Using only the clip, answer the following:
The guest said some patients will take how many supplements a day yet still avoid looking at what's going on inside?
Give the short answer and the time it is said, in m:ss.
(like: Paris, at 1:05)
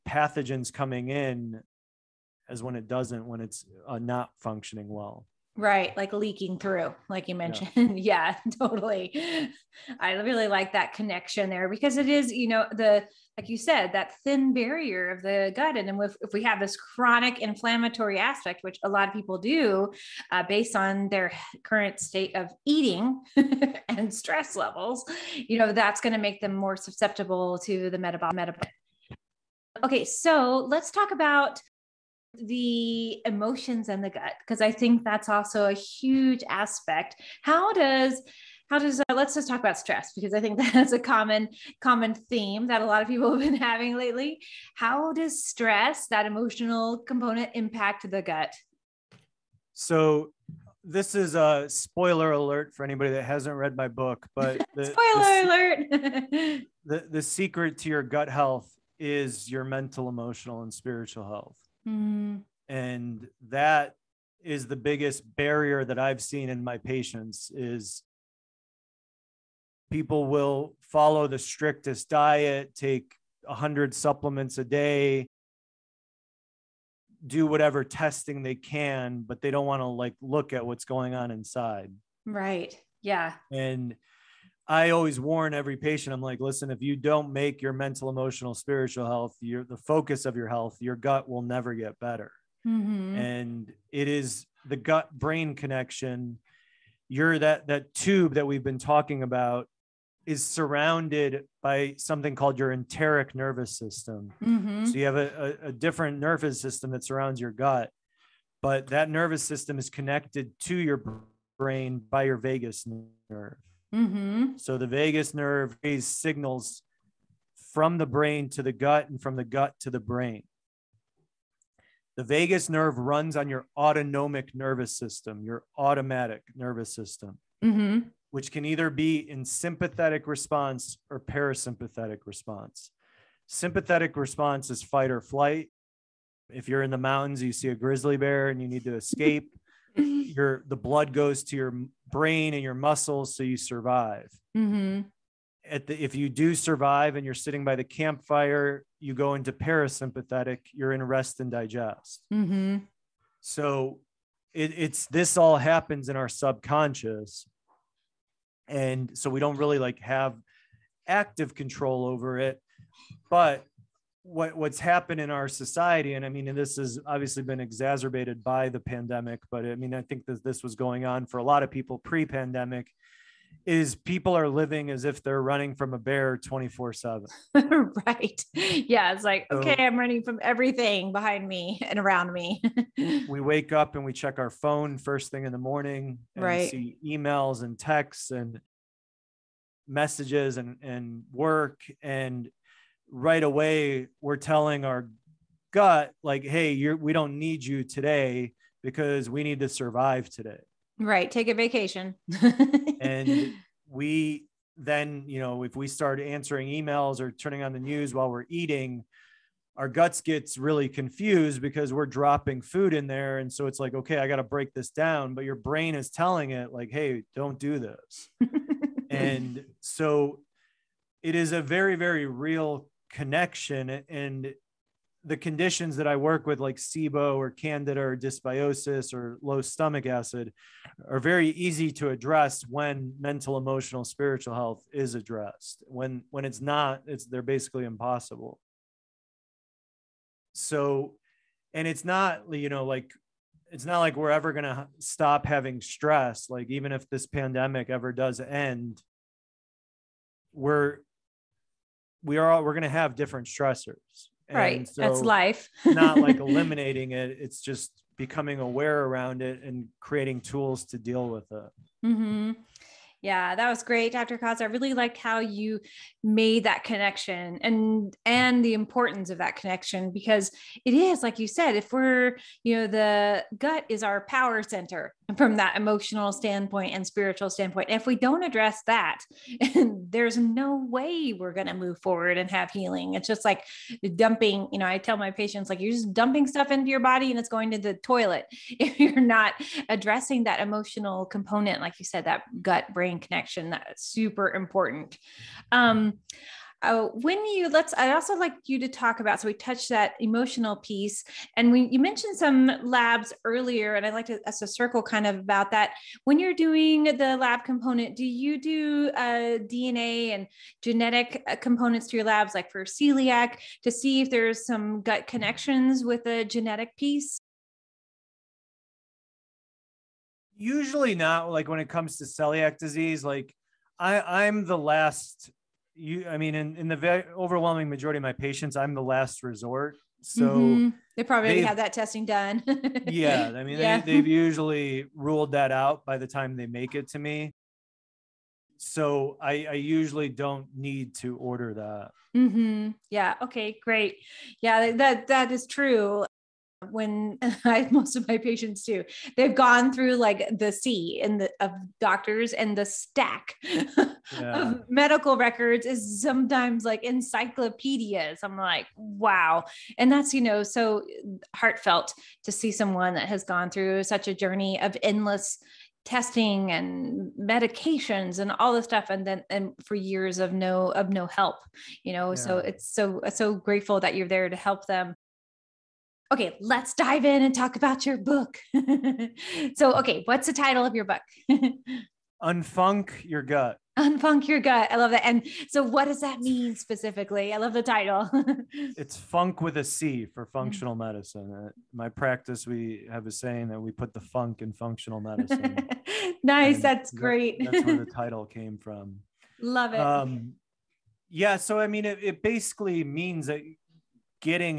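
100, at 1:13.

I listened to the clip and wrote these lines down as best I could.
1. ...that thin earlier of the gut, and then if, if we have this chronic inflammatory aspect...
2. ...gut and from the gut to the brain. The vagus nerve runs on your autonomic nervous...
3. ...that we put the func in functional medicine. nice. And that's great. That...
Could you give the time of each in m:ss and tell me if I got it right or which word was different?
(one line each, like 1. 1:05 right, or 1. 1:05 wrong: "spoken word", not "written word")
1. 0:13 wrong: "barrier", not "earlier"
2. 1:58 right
3. 6:33 right.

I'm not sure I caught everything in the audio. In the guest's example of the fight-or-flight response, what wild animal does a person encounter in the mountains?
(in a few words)
grizzly bear.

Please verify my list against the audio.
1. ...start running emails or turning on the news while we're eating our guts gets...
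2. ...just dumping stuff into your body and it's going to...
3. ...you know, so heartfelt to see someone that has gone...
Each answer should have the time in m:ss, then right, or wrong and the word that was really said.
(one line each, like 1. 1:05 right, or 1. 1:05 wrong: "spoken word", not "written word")
1. 3:25 wrong: "answering", not "running"
2. 4:45 right
3. 6:00 right.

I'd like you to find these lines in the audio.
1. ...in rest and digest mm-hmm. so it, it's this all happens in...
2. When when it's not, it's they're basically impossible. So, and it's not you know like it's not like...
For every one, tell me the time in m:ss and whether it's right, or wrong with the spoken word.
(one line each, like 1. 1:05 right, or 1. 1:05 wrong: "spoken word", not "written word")
1. 2:30 right
2. 3:55 right.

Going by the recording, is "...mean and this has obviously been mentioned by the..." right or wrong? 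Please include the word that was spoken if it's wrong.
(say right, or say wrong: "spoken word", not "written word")
wrong: "exacerbated", not "mentioned".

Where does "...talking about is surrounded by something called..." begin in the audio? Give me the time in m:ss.
1:38.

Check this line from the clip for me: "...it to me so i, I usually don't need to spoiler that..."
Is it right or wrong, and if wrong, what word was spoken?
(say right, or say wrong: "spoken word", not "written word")
wrong: "order", not "spoiler".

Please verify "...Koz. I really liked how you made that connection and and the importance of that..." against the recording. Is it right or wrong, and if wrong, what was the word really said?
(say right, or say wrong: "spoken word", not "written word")
right.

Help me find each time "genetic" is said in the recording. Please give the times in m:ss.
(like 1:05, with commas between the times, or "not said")
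5:10, 5:16.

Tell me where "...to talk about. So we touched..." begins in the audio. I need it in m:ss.
4:58.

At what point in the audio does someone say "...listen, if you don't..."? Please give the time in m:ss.
1:26.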